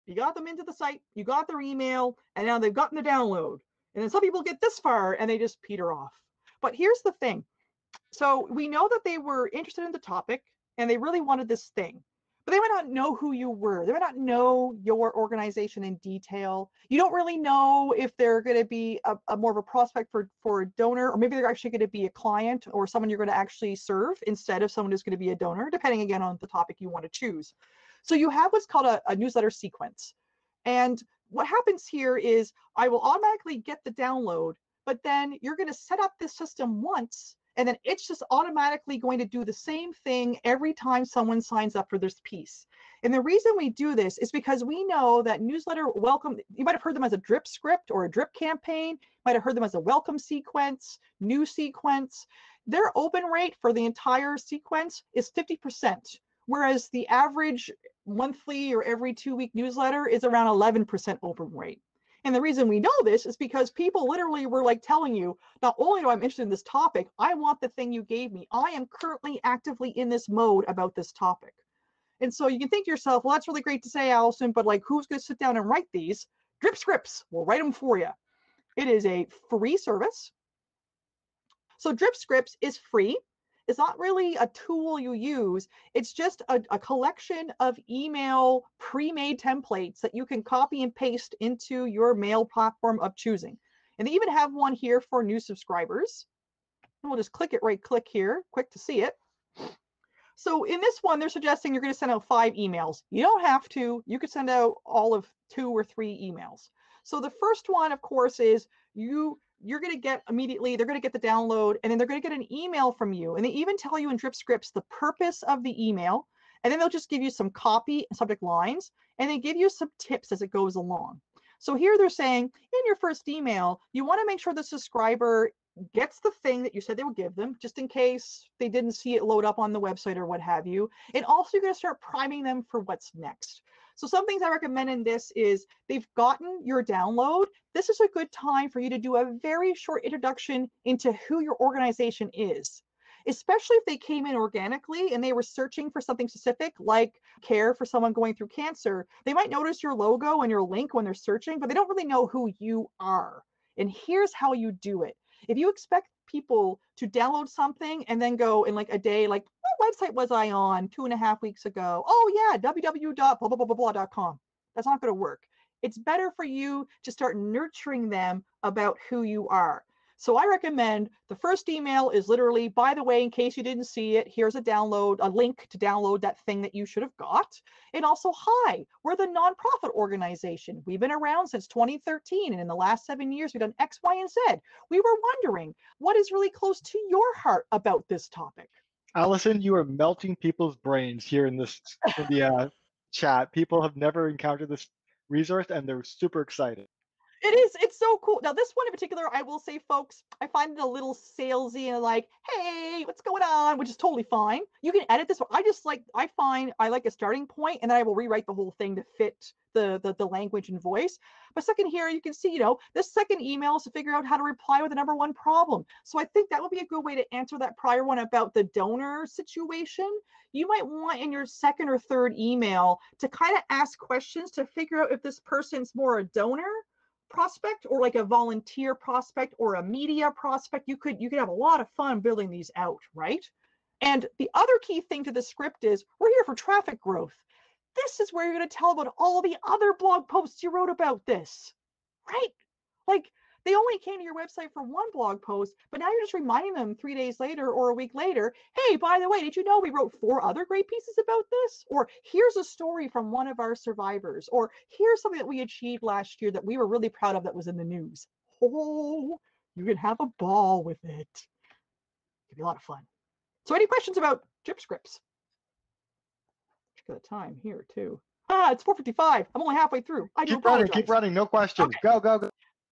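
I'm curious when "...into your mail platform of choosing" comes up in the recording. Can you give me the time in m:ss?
1:31.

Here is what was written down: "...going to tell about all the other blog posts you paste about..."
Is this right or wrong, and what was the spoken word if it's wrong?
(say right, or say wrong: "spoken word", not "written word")
wrong: "wrote", not "paste".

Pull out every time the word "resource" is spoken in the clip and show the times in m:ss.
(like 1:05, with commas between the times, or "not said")
3:15.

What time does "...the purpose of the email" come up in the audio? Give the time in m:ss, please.
1:54.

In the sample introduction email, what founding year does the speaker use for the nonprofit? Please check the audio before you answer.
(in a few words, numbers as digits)
2013.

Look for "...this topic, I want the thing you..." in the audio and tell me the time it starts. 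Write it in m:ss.
1:06.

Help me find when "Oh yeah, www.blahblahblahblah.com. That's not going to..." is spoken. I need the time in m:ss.
2:42.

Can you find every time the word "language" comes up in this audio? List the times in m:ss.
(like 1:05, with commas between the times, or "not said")
3:30.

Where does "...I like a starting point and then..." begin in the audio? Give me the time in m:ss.
3:26.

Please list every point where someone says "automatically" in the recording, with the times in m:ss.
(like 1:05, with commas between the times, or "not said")
0:32, 0:38.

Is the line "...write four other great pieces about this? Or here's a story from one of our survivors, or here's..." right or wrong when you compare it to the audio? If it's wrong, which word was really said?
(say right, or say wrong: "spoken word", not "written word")
wrong: "wrote", not "write".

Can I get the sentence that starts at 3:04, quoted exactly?
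We were wondering what is really close to your heart about this topic.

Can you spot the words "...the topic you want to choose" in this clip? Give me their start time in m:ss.
0:26.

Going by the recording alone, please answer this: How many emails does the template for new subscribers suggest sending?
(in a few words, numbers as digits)
5.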